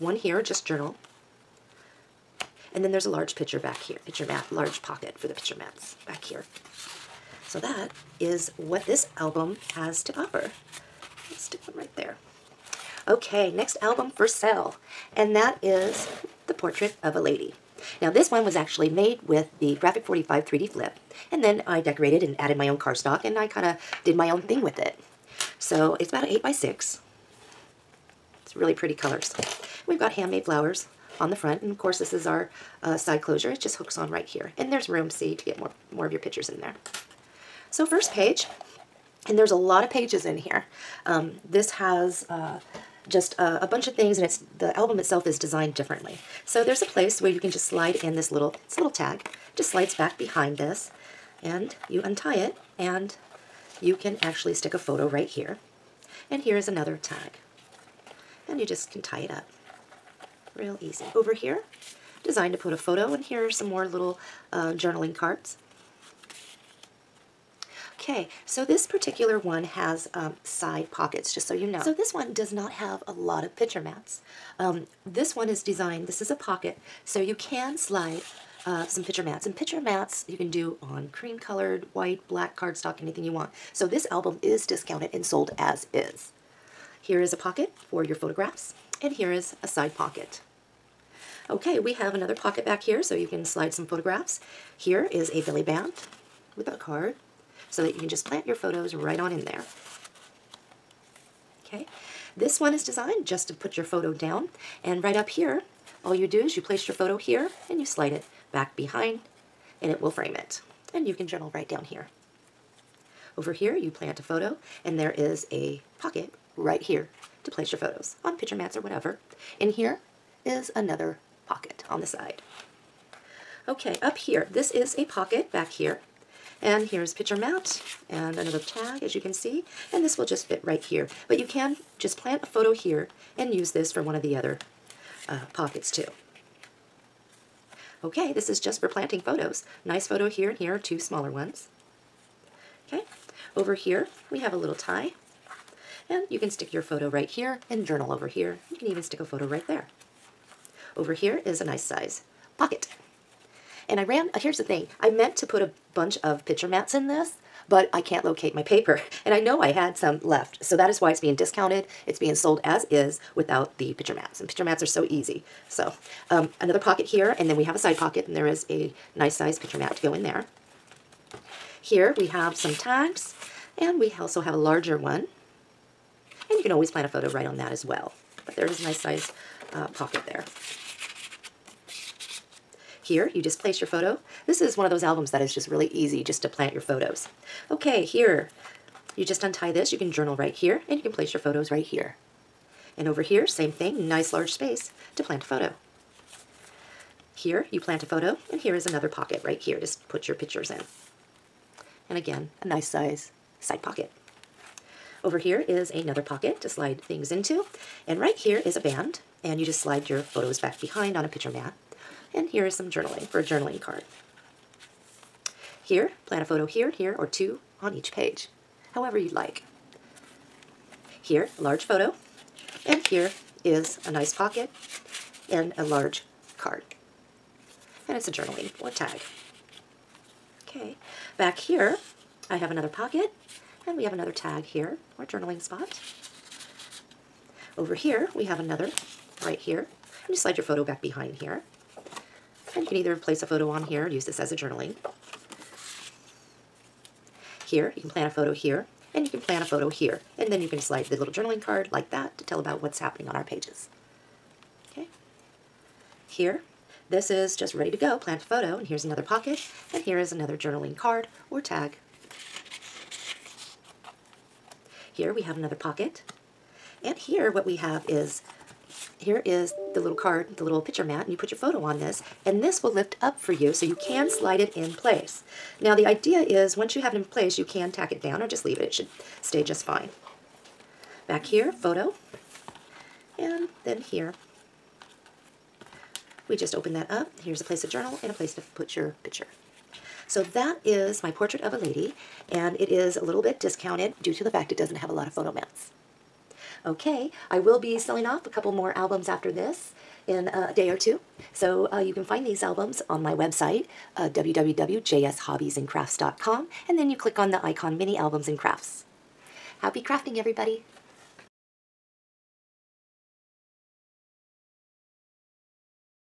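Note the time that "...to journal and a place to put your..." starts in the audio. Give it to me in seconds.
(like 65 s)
287 s.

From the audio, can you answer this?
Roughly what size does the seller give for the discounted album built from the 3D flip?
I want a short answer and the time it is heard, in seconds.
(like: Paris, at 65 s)
8 by 6, at 26 s.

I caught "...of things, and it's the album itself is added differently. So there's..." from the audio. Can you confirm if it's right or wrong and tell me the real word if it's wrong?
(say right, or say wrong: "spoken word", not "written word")
wrong: "designed", not "added".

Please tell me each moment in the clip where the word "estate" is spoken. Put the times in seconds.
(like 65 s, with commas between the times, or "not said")
not said.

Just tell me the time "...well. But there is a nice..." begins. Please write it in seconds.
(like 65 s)
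177 s.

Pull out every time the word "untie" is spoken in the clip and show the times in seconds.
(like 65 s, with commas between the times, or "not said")
52 s, 189 s.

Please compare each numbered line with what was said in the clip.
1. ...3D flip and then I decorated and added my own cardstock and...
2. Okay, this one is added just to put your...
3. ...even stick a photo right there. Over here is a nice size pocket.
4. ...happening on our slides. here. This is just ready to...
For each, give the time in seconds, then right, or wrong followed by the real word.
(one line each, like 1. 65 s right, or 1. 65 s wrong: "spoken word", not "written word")
1. 20 s right
2. 101 s wrong: "designed", not "added"
3. 148 s right
4. 252 s wrong: "pages", not "slides".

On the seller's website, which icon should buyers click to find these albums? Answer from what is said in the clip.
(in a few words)
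Mini Albums and Crafts.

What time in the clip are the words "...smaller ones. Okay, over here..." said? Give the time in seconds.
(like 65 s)
140 s.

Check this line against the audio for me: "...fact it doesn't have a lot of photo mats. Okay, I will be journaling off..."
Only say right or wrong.
wrong.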